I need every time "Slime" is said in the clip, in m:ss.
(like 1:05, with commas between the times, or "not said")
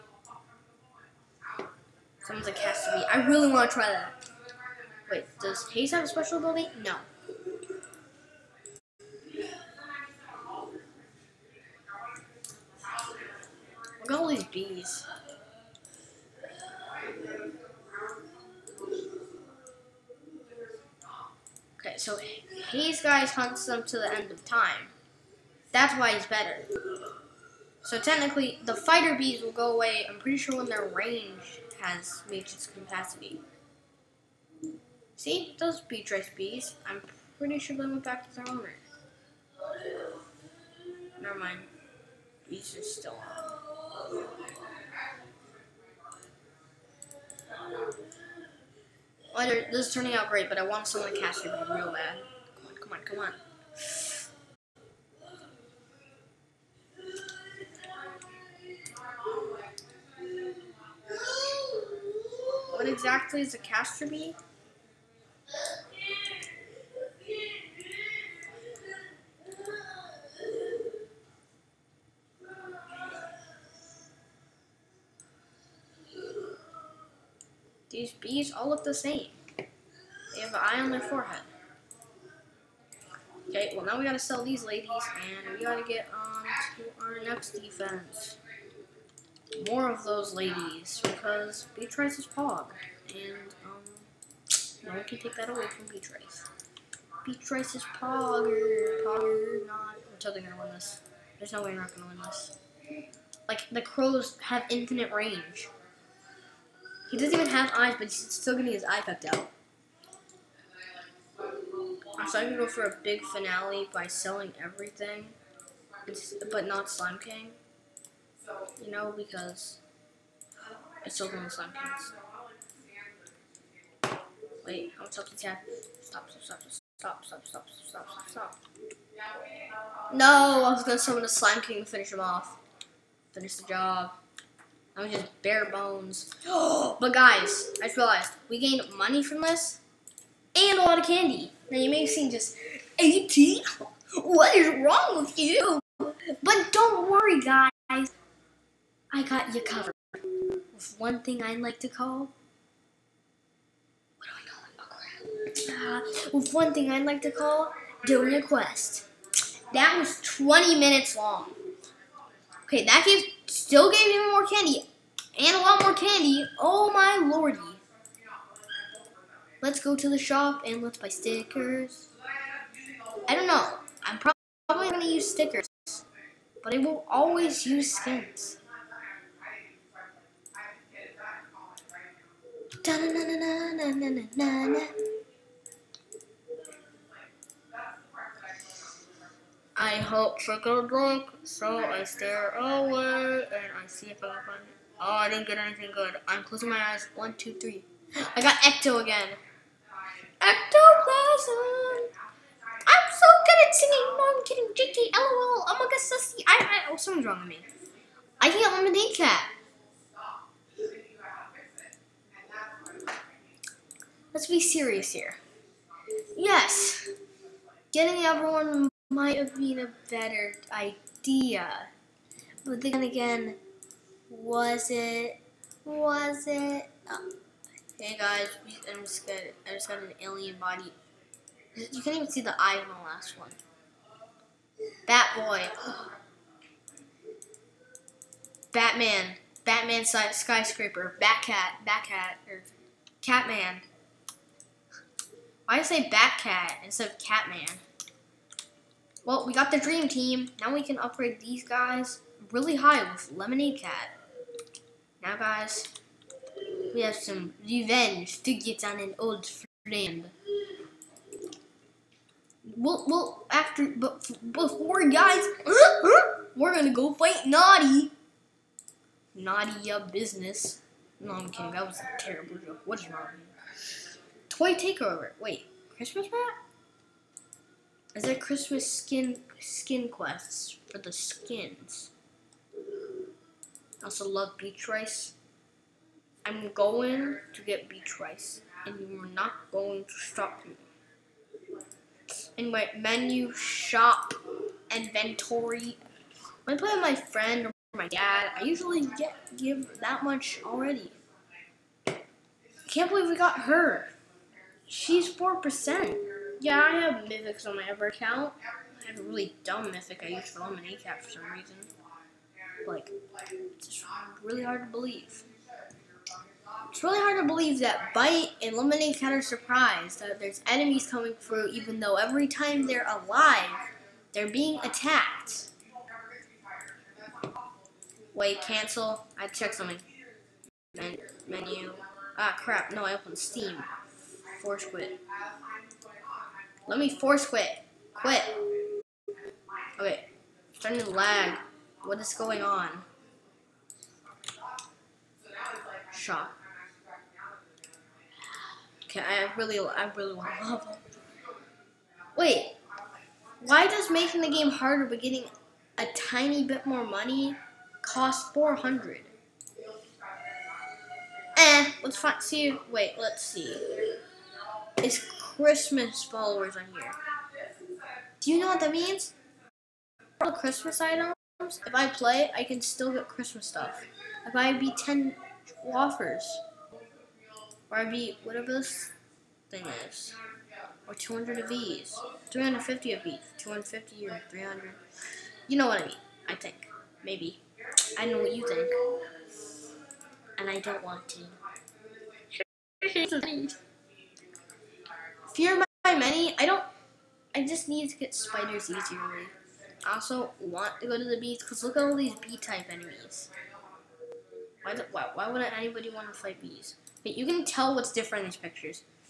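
1:56, 2:01, 2:11.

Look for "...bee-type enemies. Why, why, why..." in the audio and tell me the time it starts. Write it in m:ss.
6:42.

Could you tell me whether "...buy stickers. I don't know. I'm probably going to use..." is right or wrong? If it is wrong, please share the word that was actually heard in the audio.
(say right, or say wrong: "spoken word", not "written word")
right.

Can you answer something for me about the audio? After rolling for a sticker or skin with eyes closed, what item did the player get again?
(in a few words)
Ecto.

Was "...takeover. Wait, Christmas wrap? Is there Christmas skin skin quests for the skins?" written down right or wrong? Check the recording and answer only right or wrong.
right.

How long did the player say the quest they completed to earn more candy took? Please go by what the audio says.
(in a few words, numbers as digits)
20 minutes.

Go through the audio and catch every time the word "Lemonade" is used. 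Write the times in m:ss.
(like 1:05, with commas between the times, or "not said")
4:13, 5:10, 5:18.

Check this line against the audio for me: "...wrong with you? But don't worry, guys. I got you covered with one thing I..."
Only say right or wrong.
right.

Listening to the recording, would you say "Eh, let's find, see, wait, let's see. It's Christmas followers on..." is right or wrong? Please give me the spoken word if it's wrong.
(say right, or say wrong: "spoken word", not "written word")
right.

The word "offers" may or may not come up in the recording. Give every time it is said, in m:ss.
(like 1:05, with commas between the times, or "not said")
6:15.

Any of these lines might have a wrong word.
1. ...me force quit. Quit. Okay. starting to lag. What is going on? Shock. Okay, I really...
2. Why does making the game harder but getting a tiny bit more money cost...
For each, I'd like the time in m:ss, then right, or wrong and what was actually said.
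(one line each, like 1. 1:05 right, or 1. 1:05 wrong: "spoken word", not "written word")
1. 5:36 right
2. 5:53 right.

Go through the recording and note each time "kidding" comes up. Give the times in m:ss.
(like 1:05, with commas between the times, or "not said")
3:24, 4:31.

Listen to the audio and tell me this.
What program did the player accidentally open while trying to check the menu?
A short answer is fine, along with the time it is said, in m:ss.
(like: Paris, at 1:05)
Steam, at 5:33.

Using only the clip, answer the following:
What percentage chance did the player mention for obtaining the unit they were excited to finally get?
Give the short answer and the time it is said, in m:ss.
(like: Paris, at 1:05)
4 percent, at 5:05.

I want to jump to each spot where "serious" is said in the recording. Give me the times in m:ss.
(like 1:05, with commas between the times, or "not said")
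3:34.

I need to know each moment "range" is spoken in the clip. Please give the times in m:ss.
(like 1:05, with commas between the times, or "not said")
0:30, 1:45.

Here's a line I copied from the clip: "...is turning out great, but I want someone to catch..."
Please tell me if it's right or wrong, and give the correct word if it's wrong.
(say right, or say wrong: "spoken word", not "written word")
right.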